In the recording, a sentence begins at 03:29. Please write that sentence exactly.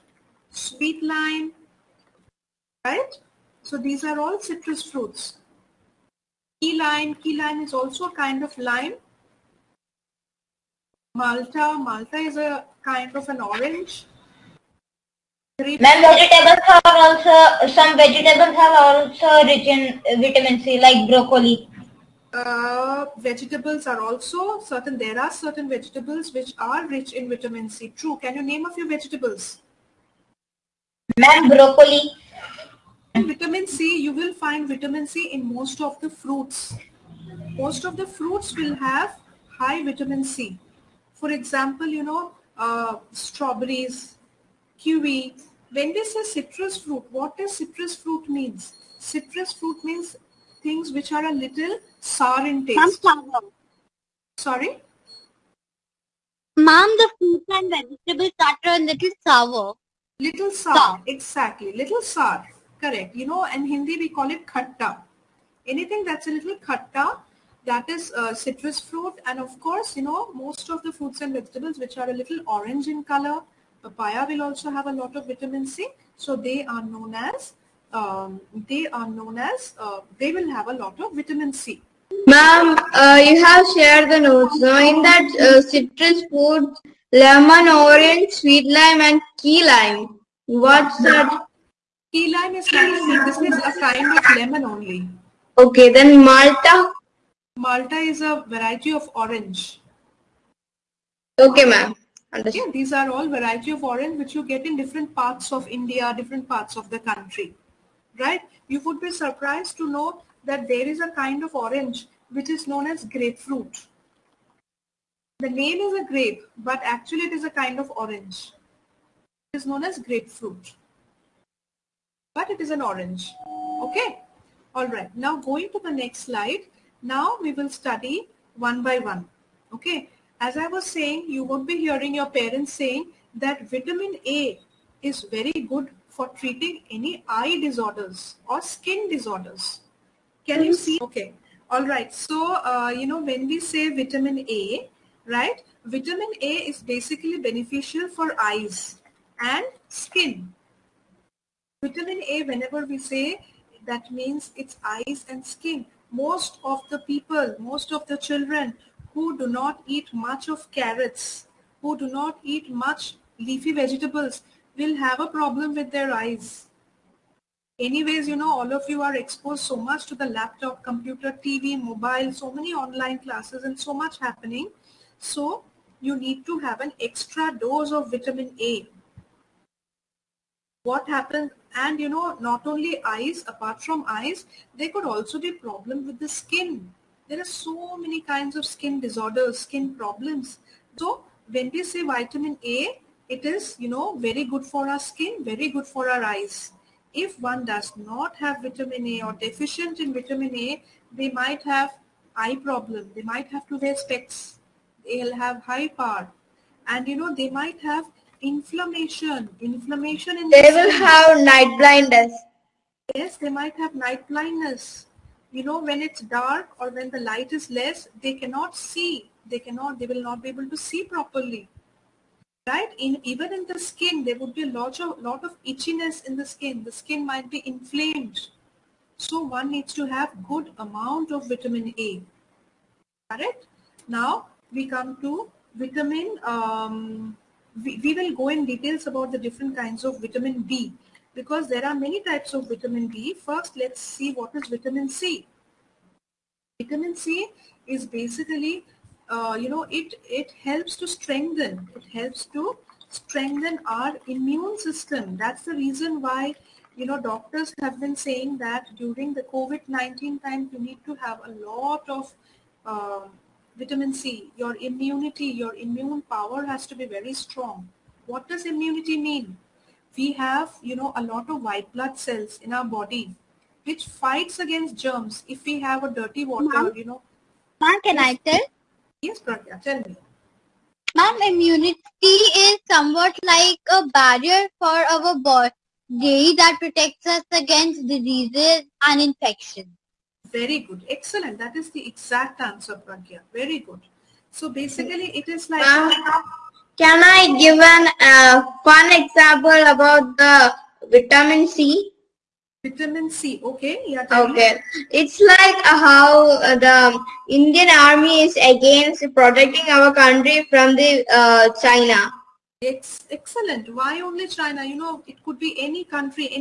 Inflammation in they will have night blindness.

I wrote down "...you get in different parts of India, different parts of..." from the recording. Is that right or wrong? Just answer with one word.
right.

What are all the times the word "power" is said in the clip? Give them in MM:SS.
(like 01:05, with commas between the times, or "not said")
03:25, 04:26.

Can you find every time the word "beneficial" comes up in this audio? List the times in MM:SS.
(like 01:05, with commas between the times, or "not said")
02:27.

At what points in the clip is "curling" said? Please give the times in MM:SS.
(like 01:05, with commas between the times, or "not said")
not said.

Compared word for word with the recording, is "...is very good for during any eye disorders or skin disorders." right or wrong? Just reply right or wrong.
wrong.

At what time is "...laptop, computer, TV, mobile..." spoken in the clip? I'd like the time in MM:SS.
02:50.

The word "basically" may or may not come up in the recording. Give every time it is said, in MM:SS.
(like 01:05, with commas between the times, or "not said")
02:26, 04:08, 04:54.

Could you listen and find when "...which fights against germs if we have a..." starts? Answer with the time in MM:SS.
04:33.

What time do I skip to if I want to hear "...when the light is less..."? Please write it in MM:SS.
03:36.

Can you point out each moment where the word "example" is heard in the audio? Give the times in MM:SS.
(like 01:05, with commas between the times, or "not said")
00:41, 04:59.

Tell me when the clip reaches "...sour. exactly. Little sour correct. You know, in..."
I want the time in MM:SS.
01:00.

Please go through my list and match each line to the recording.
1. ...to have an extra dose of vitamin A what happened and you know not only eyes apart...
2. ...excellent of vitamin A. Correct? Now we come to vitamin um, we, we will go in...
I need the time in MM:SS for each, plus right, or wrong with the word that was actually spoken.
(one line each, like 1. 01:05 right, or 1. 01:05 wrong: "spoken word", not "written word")
1. 02:56 right
2. 03:50 wrong: "amount", not "excellent".